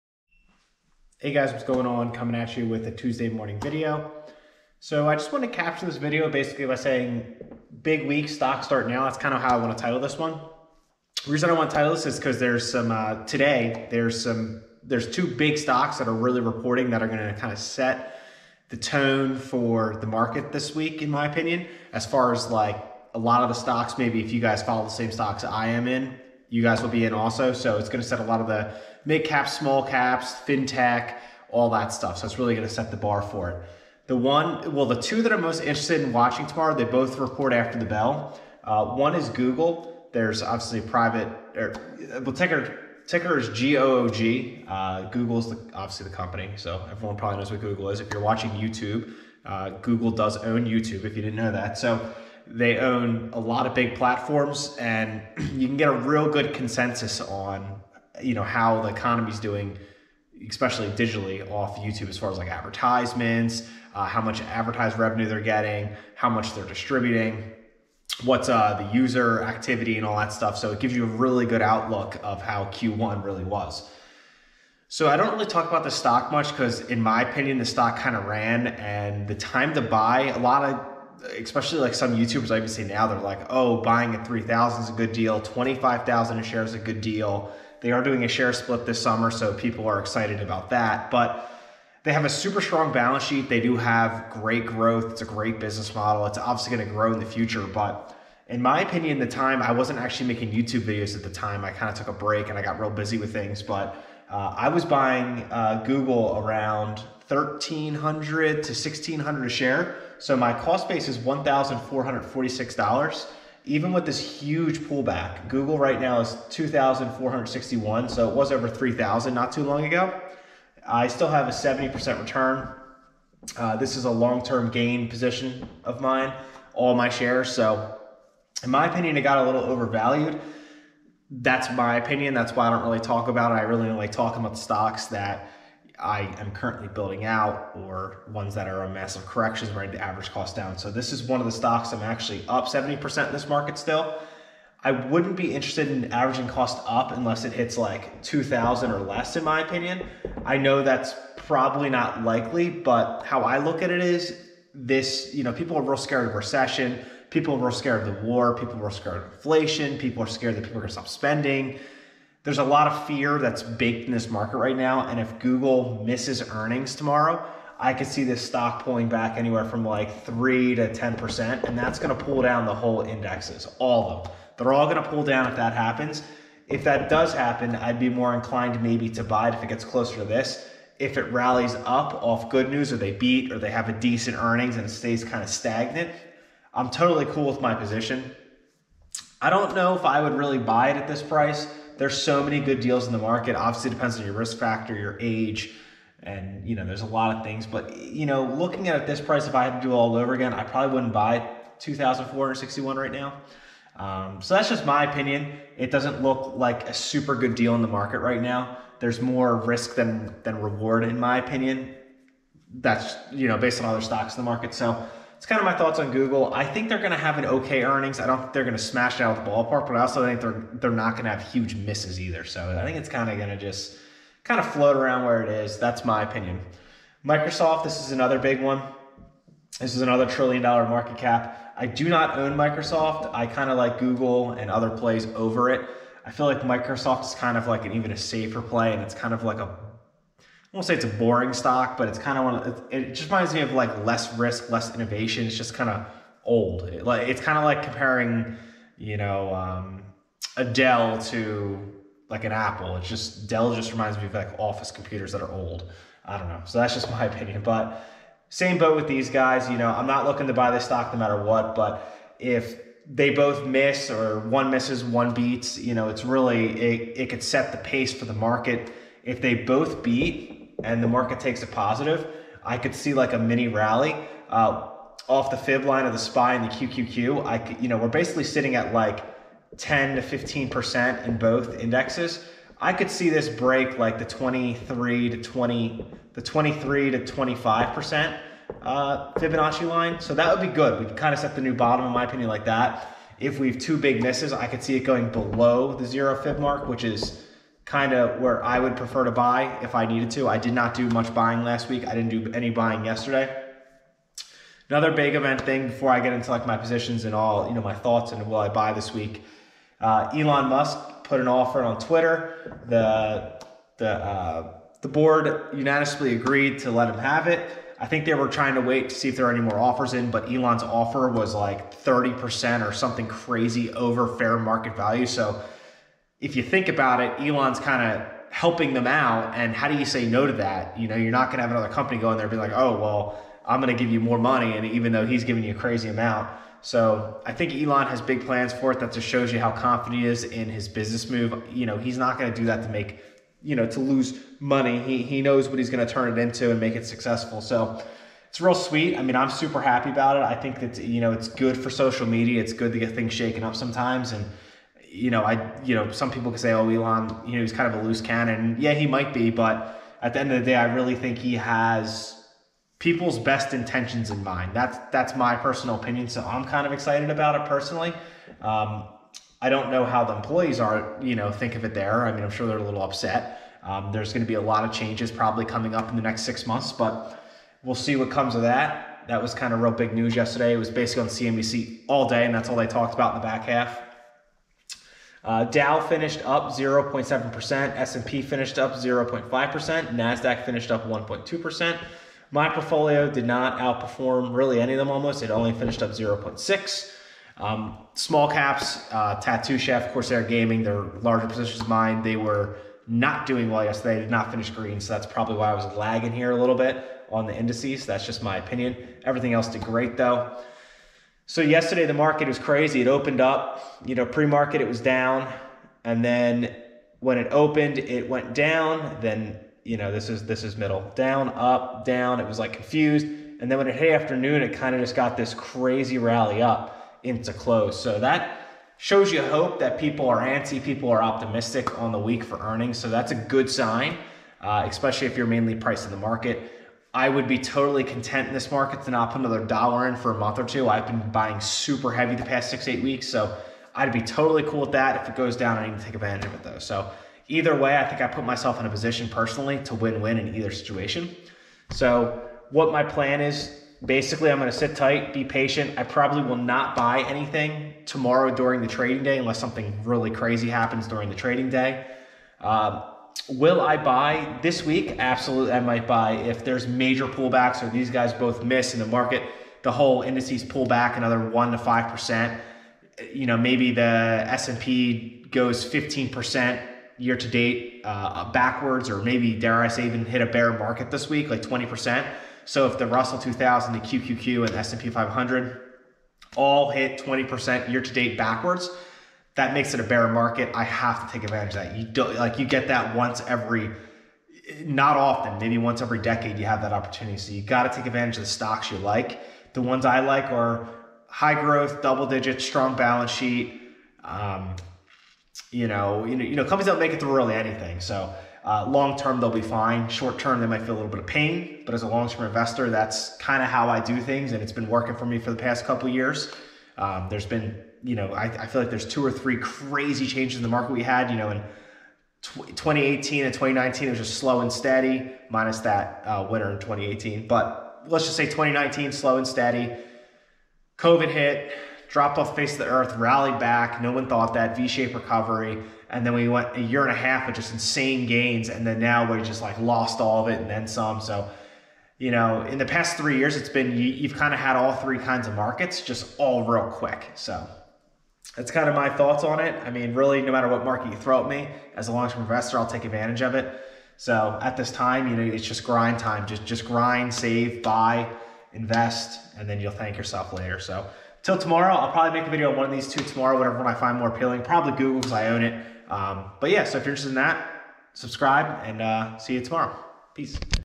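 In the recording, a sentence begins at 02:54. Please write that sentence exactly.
They're all going to pull down if that happens.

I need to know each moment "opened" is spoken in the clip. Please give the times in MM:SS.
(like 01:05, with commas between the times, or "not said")
06:53, 06:57.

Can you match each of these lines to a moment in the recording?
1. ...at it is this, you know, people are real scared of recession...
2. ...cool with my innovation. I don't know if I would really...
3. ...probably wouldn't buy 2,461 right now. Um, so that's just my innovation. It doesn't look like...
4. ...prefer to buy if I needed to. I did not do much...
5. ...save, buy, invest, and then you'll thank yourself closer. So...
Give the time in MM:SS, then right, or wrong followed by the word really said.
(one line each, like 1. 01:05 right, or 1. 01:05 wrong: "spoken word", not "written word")
1. 02:33 right
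2. 03:07 wrong: "position", not "innovation"
3. 03:20 wrong: "opinion", not "innovation"
4. 04:58 right
5. 09:17 wrong: "later", not "closer".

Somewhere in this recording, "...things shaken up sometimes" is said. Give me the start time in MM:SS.
05:53.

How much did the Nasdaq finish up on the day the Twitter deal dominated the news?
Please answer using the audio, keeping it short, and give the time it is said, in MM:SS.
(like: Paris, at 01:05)
1.2%, at 06:31.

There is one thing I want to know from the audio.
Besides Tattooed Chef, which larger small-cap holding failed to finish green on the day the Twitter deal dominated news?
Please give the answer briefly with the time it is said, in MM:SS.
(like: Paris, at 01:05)
Corsair Gaming, at 06:40.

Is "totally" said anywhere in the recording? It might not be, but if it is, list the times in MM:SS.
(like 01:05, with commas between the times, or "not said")
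03:06, 07:17, 07:24.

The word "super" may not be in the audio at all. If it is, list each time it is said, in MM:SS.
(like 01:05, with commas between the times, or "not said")
01:32, 03:26, 05:49, 07:21.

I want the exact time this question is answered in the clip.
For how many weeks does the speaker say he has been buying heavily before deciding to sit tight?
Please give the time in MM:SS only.
07:22.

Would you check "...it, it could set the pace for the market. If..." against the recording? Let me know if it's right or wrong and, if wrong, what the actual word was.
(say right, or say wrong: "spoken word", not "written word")
right.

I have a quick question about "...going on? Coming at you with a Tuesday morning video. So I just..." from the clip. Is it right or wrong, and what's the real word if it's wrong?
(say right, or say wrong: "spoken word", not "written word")
right.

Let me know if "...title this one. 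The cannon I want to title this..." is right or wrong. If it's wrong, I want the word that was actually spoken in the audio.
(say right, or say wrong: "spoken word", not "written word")
wrong: "reason", not "cannon".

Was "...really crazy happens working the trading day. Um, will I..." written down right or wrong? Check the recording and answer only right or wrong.
wrong.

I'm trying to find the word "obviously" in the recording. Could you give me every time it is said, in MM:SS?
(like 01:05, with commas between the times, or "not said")
00:40, 00:45, 01:36, 03:13.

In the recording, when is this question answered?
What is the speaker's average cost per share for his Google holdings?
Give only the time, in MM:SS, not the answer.
01:51.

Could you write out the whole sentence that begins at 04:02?
Of, it, it just reminds me of like less risk, less innovation.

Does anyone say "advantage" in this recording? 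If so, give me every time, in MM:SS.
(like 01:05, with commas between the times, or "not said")
07:26, 08:11, 08:18, 09:13.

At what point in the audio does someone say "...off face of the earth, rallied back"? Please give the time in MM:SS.
08:52.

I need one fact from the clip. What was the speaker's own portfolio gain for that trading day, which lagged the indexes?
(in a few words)
0.6.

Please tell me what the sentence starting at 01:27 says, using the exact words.
They are doing a share split this summer, so people are excited about that.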